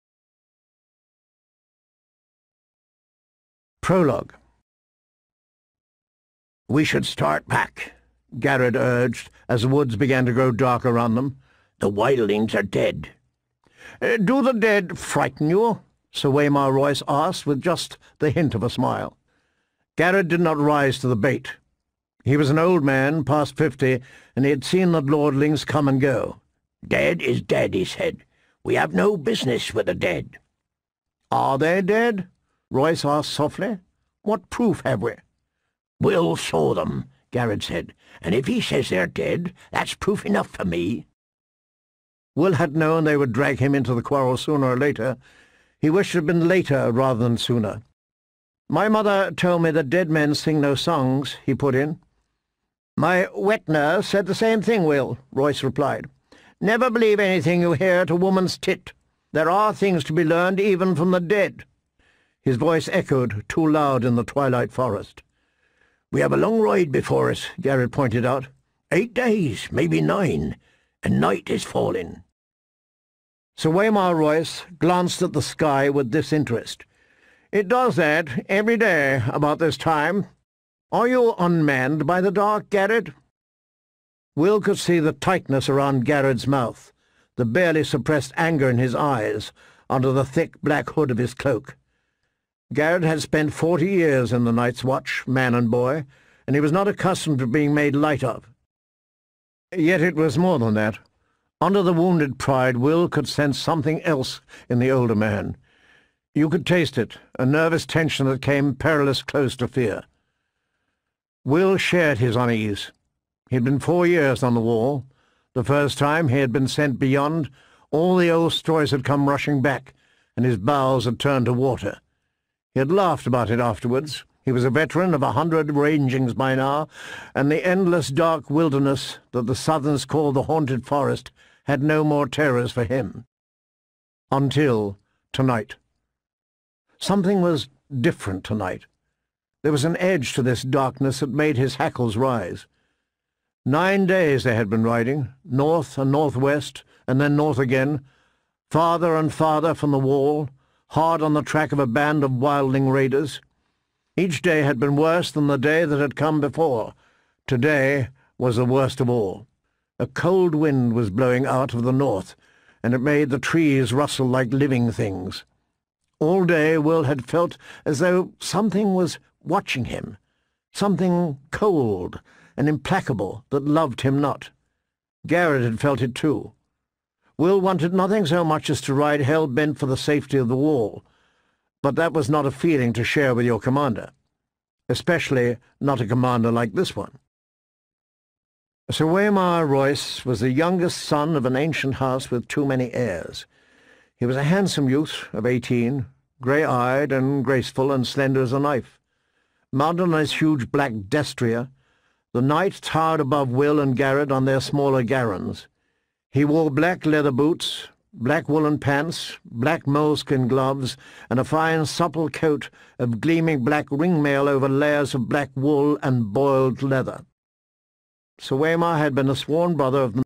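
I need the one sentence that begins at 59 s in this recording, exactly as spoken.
There are things to be learned even from the dead.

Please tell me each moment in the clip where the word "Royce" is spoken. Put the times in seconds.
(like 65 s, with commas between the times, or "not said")
16 s, 32 s, 55 s, 74 s, 189 s.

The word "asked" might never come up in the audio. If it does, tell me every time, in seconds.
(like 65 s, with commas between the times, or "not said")
17 s, 33 s.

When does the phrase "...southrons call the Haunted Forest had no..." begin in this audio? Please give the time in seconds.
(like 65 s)
129 s.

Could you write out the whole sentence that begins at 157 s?
Today was the worst of all.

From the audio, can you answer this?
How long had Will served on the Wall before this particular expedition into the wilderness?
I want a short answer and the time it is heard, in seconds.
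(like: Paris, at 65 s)
4 years, at 113 s.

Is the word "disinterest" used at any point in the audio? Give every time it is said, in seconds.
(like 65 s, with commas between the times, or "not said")
76 s.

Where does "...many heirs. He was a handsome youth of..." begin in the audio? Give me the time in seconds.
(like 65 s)
192 s.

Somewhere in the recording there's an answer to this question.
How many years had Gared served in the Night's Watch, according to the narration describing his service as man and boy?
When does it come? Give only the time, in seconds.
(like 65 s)
93 s.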